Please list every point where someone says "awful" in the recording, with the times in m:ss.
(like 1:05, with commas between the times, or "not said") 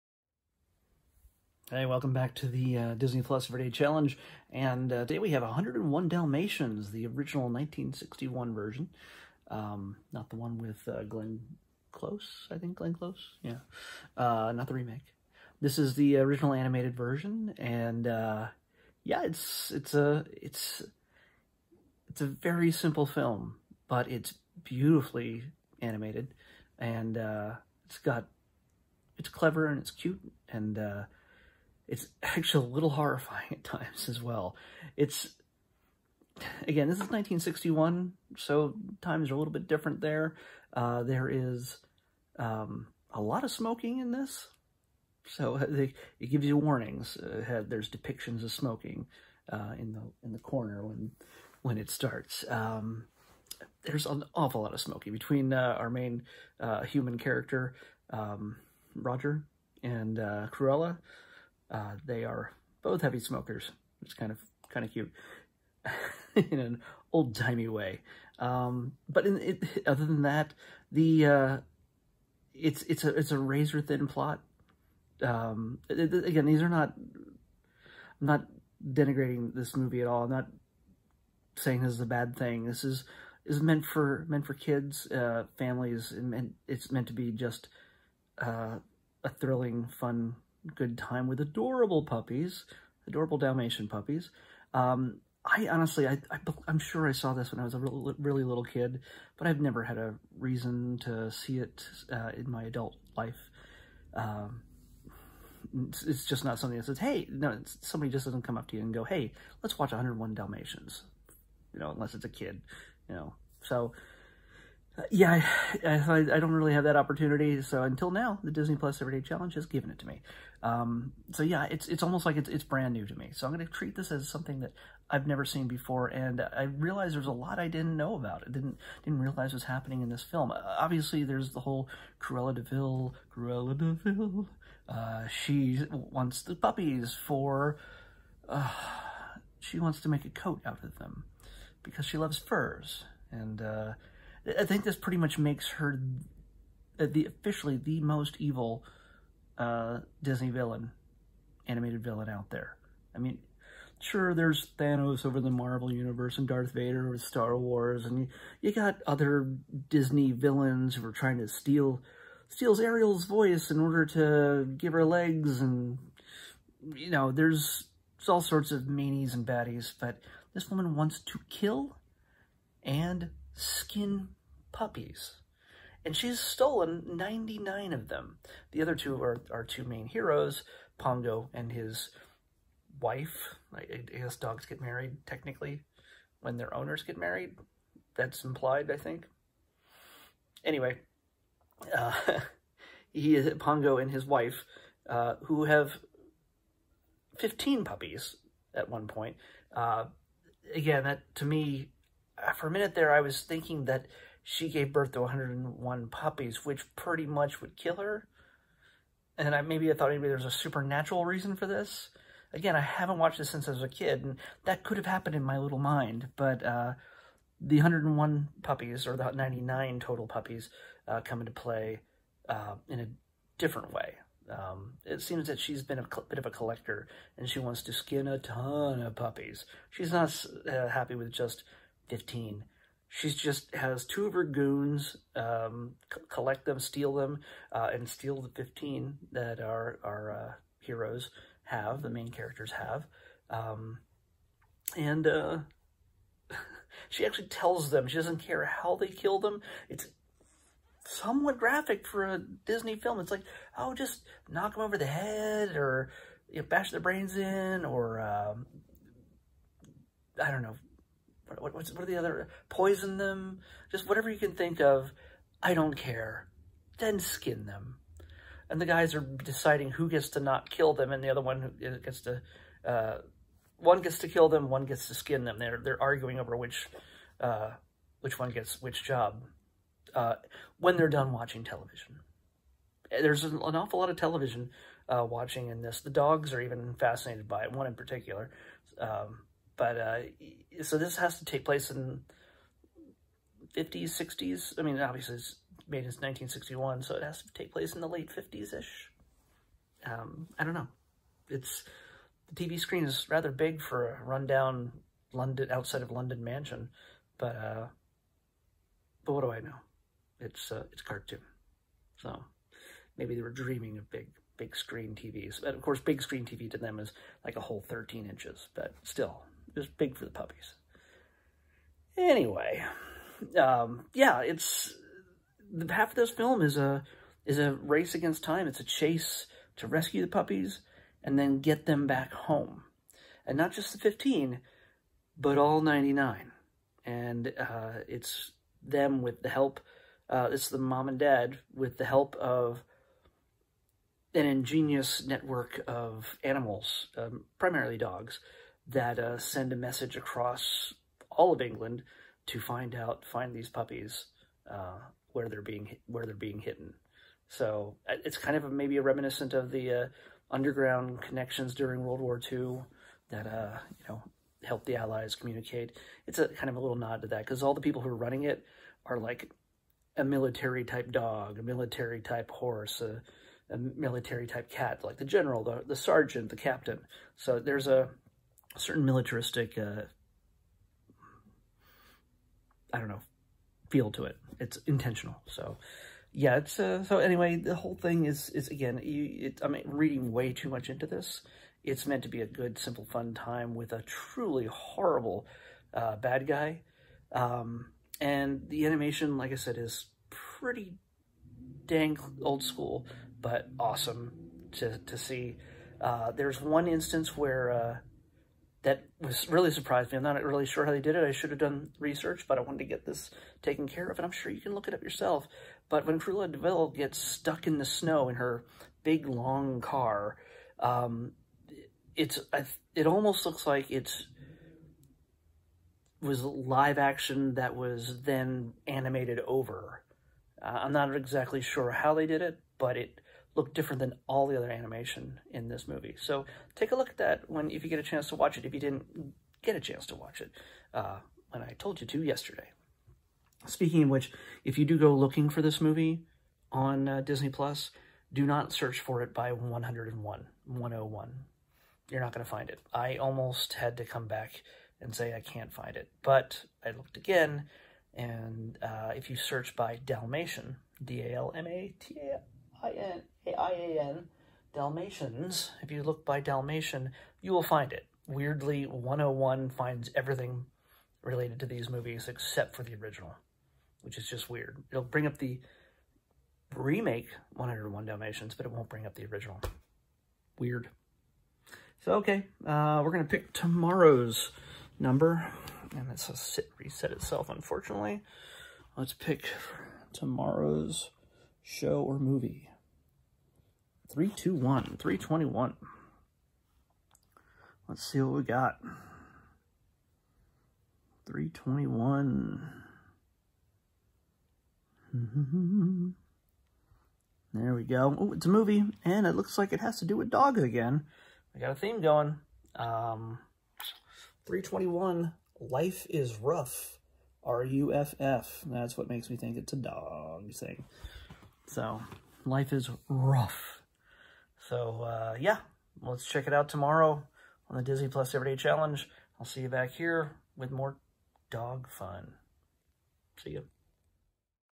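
0:54, 4:43.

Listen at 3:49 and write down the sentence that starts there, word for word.
She's not uh, happy with just 15.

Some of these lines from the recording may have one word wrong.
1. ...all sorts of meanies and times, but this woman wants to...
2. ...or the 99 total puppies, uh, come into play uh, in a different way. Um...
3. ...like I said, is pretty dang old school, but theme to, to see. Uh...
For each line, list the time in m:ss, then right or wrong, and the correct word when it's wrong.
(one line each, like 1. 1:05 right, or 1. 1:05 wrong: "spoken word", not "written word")
1. 2:48 wrong: "baddies", not "times"
2. 3:39 right
3. 6:39 wrong: "awesome", not "theme".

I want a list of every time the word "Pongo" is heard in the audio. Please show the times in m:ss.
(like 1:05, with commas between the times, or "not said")
3:00, 3:13.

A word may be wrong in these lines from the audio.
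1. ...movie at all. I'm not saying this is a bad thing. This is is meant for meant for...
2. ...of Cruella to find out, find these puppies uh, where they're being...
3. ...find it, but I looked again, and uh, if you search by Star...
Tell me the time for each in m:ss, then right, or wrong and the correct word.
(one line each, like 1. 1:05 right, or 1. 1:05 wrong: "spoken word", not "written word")
1. 1:19 right
2. 5:51 wrong: "England", not "Cruella"
3. 7:35 wrong: "Dalmatian", not "Star".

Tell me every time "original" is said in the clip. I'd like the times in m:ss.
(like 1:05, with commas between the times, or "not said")
0:07, 0:16, 7:52, 7:59.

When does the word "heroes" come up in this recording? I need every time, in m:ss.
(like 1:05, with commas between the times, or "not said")
3:00, 4:00.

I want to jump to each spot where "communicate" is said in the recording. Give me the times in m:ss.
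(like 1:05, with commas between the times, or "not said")
6:05.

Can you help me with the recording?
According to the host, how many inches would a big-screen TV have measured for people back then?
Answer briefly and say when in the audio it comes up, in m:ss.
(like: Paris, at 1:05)
13 inches, at 5:17.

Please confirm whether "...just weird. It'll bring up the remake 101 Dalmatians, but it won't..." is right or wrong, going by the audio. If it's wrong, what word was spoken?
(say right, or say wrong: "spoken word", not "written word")
right.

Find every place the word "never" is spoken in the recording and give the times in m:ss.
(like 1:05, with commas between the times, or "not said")
1:39, 2:05.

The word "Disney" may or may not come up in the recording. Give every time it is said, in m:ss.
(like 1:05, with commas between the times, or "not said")
0:02, 1:58, 2:30, 2:39, 4:12, 7:27, 8:47.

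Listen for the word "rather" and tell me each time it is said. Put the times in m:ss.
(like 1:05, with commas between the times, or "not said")
5:03.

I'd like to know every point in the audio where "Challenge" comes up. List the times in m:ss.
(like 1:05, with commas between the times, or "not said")
0:03, 1:59, 8:48.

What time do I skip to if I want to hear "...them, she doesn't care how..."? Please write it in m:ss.
4:07.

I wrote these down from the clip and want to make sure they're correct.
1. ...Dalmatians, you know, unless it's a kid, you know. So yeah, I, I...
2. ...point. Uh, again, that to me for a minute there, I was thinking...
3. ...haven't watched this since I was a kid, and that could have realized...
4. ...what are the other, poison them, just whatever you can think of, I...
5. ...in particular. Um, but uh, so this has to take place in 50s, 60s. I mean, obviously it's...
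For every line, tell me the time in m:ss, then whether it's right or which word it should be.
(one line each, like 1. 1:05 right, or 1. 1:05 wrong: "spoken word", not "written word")
1. 1:50 right
2. 3:19 right
3. 3:32 wrong: "happened", not "realized"
4. 4:21 right
5. 4:47 right.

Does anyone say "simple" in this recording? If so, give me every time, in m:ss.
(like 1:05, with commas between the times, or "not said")
0:22, 6:32.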